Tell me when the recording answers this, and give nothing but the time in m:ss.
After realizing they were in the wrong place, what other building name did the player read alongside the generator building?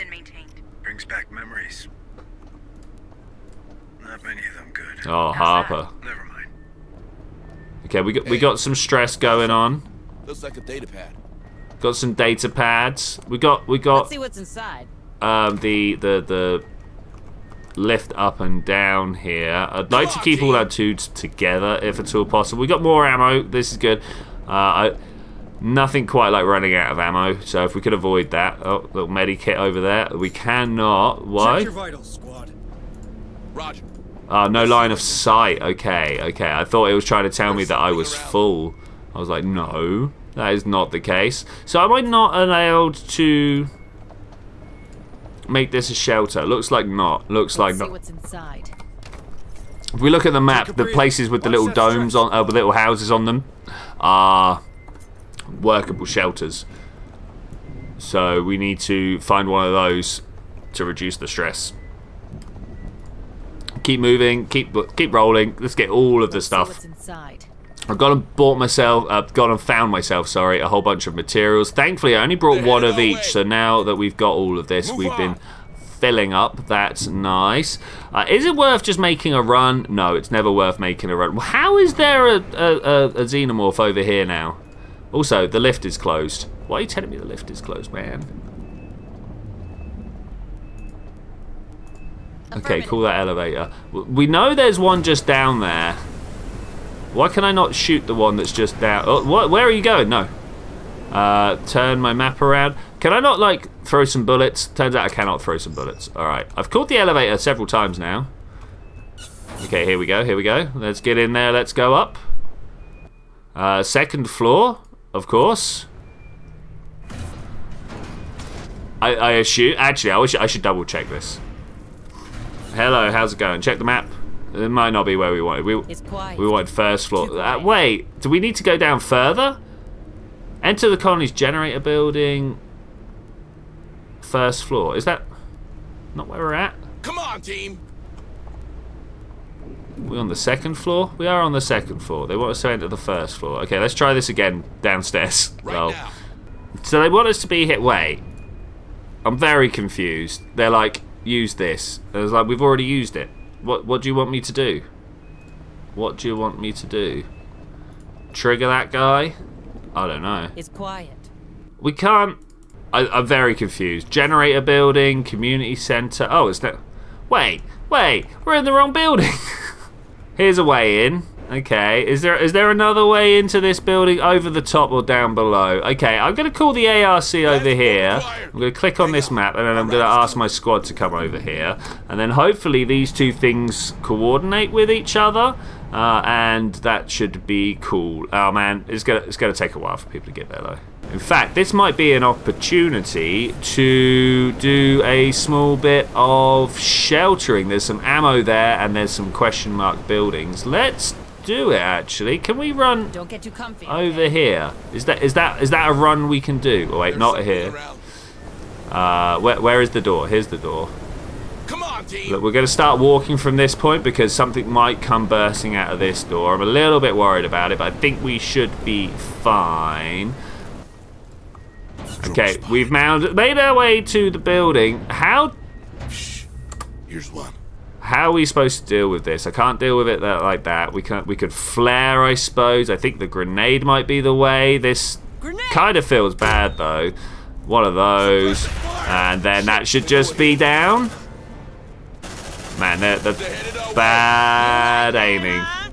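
2:45.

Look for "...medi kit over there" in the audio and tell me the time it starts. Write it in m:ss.
0:29.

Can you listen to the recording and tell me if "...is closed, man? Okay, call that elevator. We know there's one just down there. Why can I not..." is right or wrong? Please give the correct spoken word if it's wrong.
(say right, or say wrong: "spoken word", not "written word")
right.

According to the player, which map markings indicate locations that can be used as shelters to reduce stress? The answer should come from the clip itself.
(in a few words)
Little domes.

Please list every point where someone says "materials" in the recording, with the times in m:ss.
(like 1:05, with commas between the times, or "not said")
1:11.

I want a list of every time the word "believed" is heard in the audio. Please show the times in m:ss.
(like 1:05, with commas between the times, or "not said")
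not said.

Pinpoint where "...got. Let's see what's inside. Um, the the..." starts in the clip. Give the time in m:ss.
0:13.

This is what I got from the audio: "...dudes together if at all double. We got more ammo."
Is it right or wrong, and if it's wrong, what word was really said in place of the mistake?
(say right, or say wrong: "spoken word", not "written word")
wrong: "possible", not "double".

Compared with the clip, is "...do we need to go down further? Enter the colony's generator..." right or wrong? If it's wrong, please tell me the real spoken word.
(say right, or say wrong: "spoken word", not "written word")
right.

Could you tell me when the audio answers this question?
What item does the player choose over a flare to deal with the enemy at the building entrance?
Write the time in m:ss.
3:53.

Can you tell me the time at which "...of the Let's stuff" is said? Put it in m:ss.
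1:06.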